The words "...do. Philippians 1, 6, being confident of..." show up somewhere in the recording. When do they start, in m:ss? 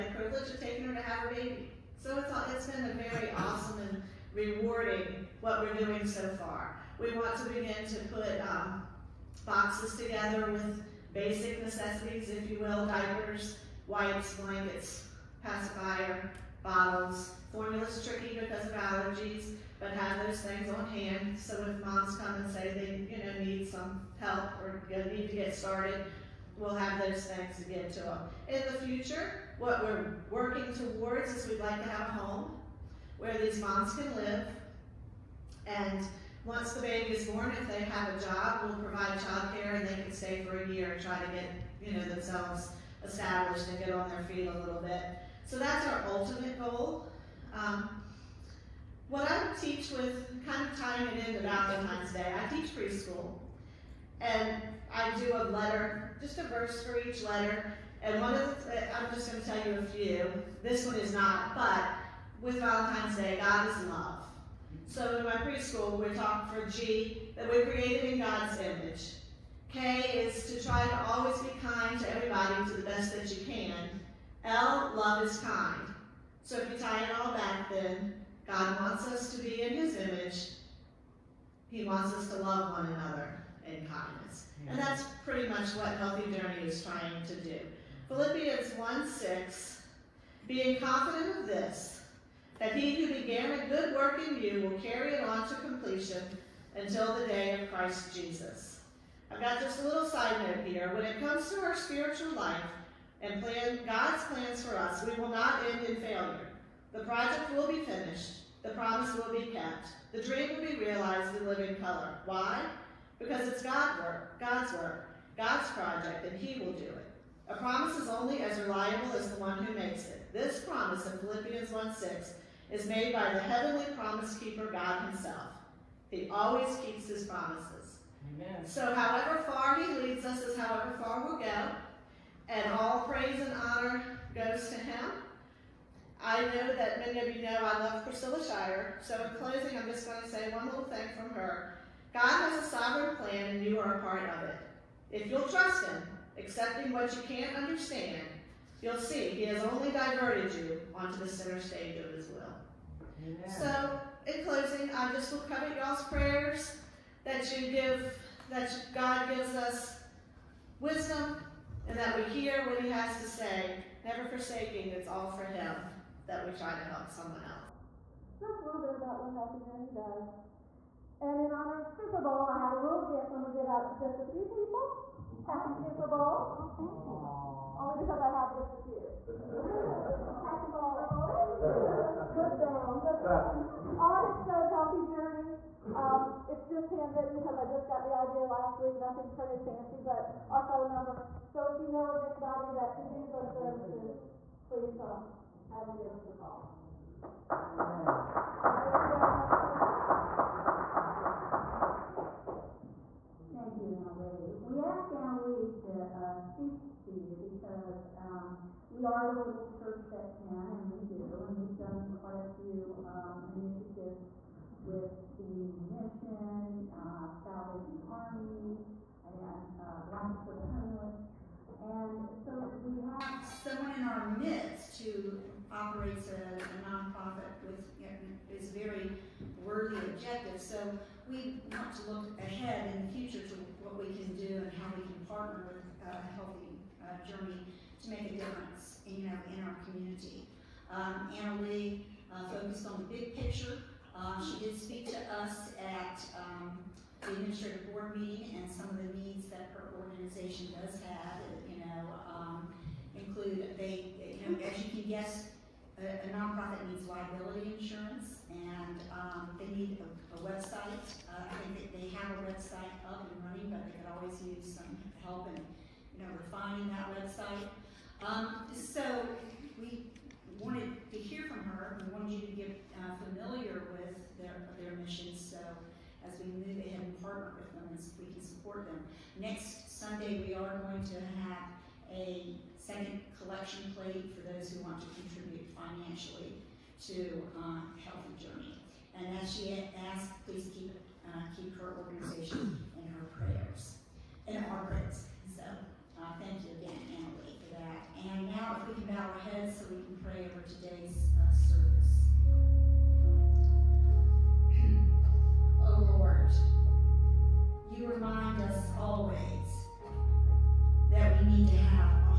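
1:27.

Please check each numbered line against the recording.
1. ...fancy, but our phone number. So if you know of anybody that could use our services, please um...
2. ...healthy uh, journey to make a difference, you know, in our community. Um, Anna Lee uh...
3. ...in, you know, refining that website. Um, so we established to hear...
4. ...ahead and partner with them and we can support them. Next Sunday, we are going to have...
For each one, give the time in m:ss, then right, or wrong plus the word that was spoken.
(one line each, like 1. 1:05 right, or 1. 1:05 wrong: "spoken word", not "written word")
1. 3:09 right
2. 3:56 right
3. 4:25 wrong: "wanted", not "established"
4. 4:36 right.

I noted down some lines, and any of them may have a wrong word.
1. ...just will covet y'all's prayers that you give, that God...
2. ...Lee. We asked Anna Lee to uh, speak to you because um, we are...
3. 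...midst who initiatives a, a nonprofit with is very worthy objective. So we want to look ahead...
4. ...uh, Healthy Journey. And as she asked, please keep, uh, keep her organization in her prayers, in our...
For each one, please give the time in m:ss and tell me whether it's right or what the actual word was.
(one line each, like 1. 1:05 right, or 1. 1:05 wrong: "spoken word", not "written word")
1. 2:35 right
2. 3:24 right
3. 3:44 wrong: "operates", not "initiatives"
4. 4:47 right.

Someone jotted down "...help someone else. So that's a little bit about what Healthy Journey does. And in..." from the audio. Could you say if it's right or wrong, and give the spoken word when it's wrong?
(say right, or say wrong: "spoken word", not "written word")
right.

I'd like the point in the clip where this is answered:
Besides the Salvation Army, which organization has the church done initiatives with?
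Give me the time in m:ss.
3:40.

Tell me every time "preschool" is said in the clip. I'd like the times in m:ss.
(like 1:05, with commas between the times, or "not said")
0:52, 1:05.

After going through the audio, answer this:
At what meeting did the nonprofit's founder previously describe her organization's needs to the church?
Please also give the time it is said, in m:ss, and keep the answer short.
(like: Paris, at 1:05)
Administrative board meeting, at 4:07.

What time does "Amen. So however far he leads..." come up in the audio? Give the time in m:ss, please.
2:08.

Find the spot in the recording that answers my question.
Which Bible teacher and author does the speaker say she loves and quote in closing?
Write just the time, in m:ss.
2:18.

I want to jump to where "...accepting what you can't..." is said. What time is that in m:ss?
2:26.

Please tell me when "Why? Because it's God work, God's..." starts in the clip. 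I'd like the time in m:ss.
1:52.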